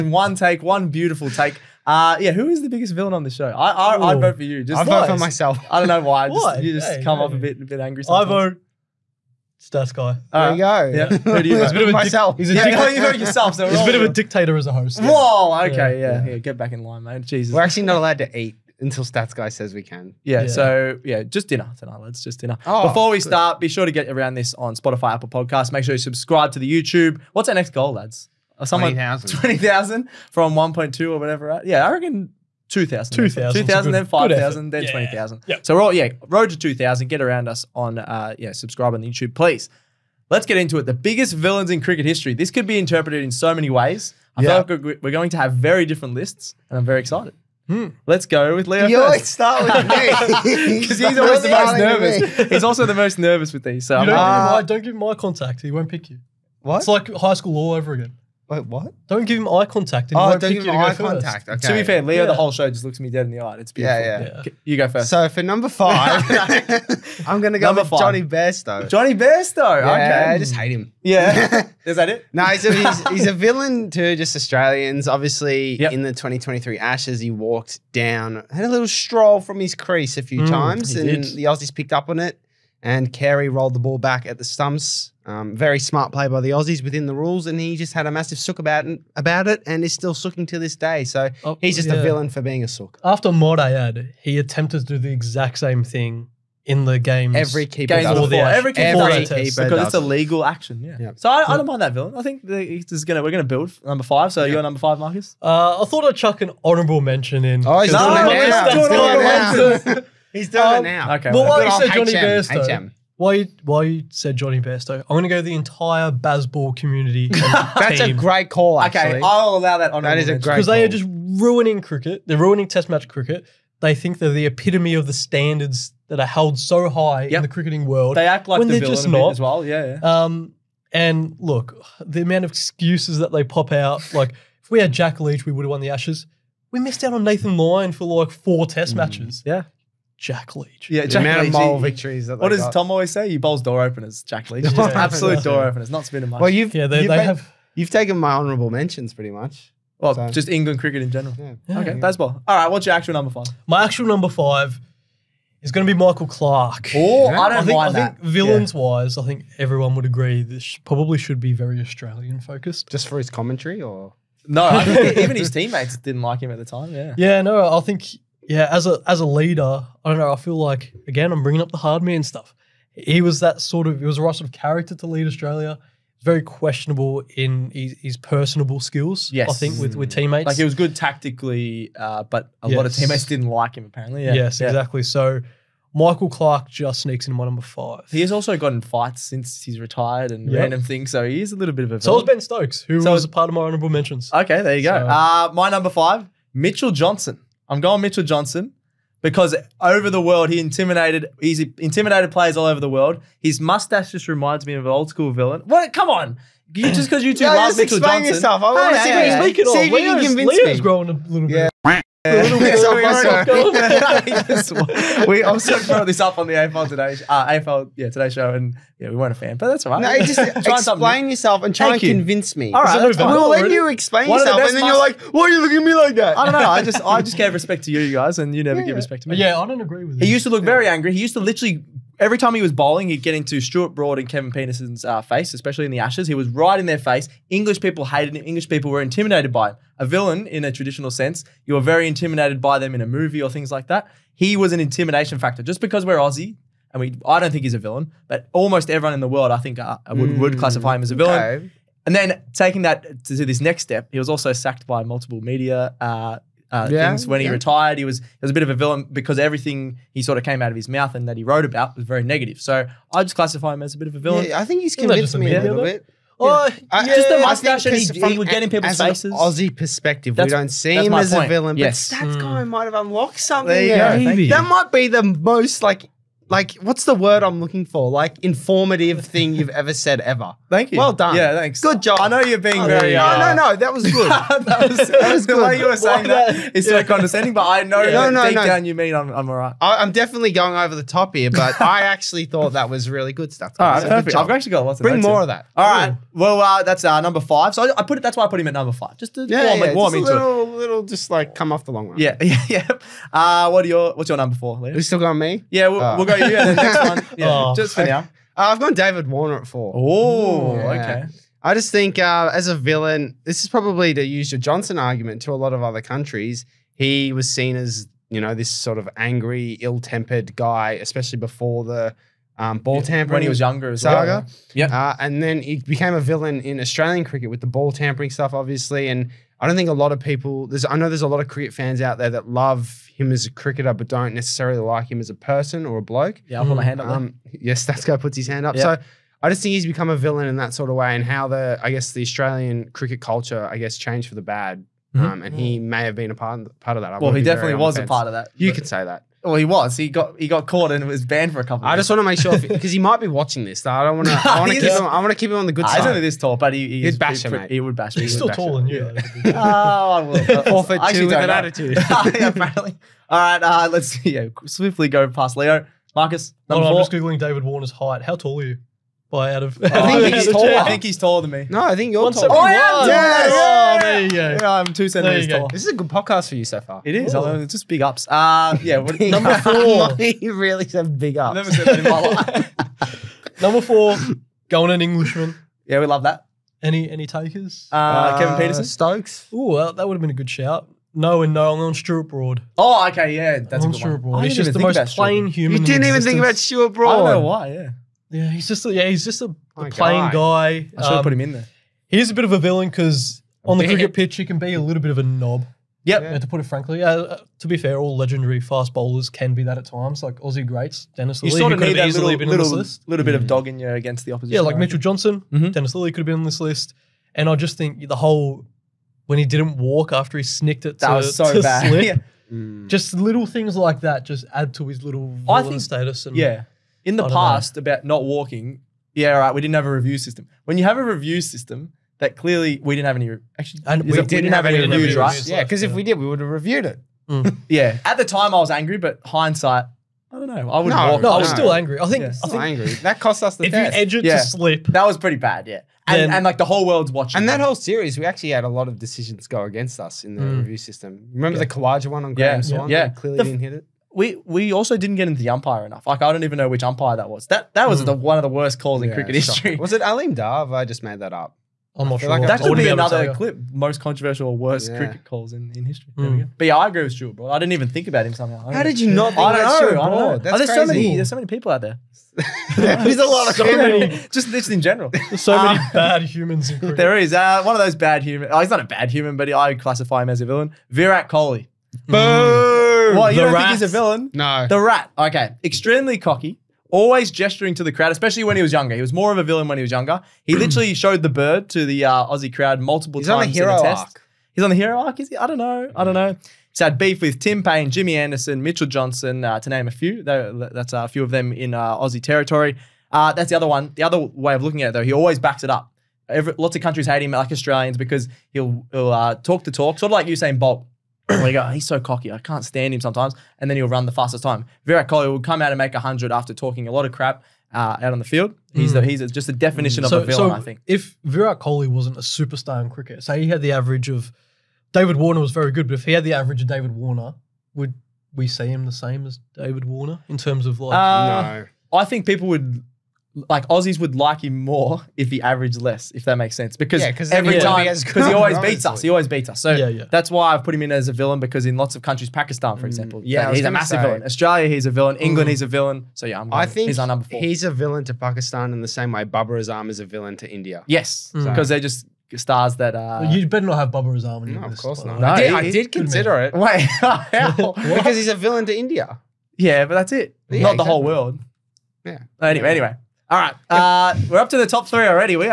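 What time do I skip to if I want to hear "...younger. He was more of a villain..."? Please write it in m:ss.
8:08.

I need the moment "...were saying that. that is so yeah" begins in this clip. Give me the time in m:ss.
4:45.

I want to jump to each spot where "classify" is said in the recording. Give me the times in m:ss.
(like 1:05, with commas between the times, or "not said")
4:10, 4:23, 7:59.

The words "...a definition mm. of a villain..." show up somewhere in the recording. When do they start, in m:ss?
8:39.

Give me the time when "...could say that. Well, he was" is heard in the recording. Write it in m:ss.
5:48.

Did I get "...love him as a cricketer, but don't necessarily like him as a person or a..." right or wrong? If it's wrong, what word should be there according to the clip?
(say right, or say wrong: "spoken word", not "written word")
right.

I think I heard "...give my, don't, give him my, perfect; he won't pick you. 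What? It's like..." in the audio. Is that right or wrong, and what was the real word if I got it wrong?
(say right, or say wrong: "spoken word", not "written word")
wrong: "contact", not "perfect".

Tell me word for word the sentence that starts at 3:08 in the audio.
He has also gotten fights since he's retired and yep.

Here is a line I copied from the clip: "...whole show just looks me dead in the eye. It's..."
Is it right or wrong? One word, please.
right.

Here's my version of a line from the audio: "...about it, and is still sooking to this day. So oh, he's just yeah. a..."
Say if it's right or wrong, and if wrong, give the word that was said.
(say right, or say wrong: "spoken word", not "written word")
right.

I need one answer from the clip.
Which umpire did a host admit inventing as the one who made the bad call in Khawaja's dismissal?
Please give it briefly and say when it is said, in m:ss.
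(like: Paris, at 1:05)
Aleem Dar, at 7:40.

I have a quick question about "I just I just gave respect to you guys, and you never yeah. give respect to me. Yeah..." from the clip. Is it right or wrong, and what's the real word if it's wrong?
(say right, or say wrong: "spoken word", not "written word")
right.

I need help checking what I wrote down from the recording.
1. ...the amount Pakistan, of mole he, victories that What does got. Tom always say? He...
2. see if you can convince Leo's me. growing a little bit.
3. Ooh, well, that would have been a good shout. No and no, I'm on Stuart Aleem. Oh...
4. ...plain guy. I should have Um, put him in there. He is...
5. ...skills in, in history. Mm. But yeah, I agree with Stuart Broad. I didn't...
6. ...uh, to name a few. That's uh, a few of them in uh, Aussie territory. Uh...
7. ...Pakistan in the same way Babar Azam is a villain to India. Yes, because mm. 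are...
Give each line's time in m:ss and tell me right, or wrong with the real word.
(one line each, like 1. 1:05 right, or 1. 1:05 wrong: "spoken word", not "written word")
1. 2:21 wrong: "Leach", not "Pakistan"
2. 3:29 right
3. 6:29 wrong: "Broad", not "Aleem"
4. 6:39 right
5. 7:45 wrong: "calls", not "skills"
6. 8:19 right
7. 9:08 right.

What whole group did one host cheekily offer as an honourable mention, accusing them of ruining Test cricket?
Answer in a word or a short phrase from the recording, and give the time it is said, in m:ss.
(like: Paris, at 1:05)
the entire Bazball community, at 1:55.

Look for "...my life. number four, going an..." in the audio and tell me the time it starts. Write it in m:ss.
6:22.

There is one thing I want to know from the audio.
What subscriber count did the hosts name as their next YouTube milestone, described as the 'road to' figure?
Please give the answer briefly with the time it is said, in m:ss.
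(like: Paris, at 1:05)
2,000, at 0:36.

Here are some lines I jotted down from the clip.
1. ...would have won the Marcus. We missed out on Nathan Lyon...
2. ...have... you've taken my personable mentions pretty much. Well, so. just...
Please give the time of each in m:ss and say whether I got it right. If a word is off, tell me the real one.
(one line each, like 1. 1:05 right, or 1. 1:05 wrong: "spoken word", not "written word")
1. 2:15 wrong: "Ashes", not "Marcus"
2. 2:27 wrong: "honourable", not "personable".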